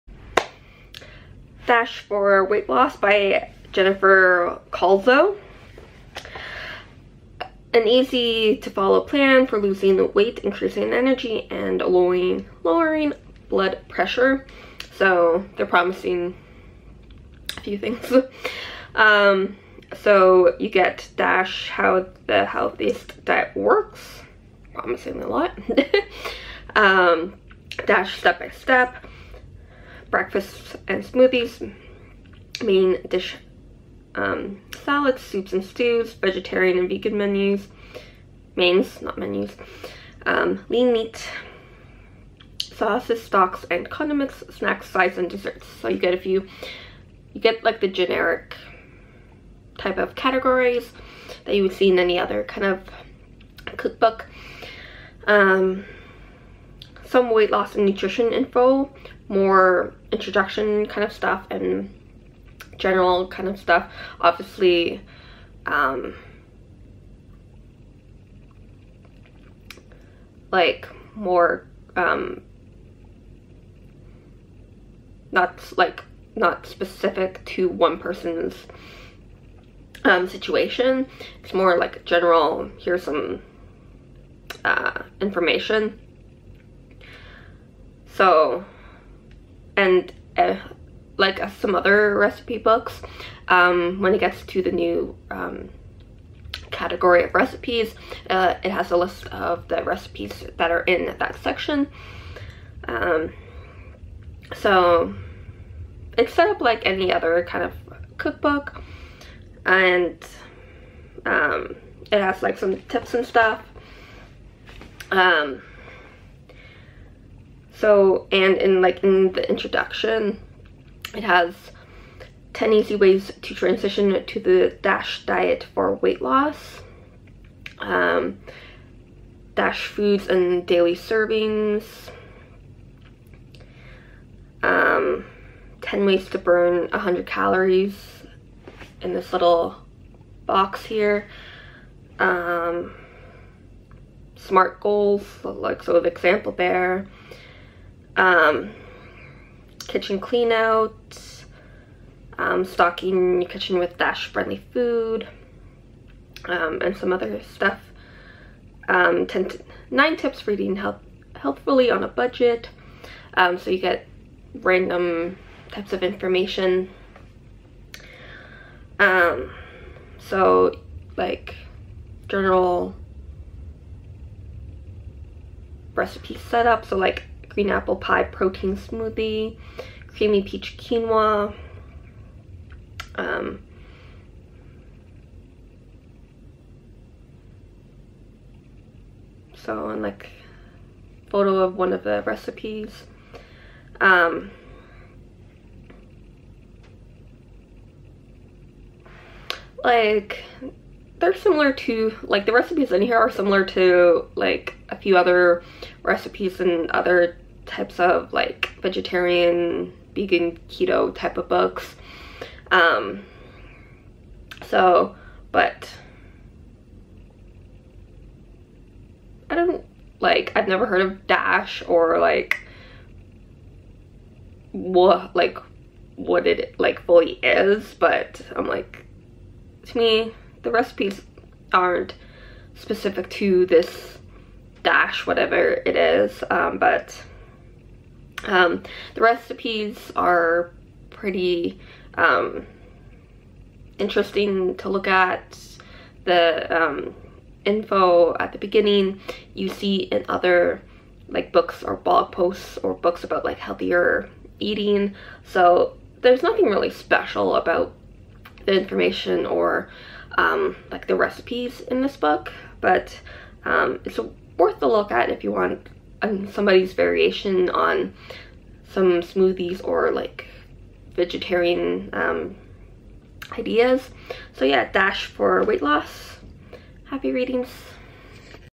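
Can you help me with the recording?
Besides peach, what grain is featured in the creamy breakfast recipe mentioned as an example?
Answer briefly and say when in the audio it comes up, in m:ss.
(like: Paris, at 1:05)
Quinoa, at 3:00.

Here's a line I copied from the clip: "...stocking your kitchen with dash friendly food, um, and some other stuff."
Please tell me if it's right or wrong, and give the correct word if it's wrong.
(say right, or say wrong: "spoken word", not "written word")
right.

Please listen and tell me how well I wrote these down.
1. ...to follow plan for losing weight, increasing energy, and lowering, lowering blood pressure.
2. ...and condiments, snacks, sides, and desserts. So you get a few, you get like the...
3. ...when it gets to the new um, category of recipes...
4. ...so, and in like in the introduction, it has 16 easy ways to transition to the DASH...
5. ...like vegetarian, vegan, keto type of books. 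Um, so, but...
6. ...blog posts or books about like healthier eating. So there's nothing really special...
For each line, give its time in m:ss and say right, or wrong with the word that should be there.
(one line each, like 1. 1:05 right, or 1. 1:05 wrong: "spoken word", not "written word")
1. 0:08 right
2. 0:43 right
3. 1:33 right
4. 1:57 wrong: "10", not "16"
5. 3:28 right
6. 4:11 right.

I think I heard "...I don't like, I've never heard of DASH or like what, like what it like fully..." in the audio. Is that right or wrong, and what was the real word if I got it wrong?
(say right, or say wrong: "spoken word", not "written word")
right.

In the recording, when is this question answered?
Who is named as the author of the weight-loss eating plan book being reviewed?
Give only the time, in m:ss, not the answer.
0:03.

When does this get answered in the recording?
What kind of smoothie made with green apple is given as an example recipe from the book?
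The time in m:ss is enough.
2:57.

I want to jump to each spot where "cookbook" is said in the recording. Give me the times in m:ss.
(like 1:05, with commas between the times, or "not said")
0:53, 1:48.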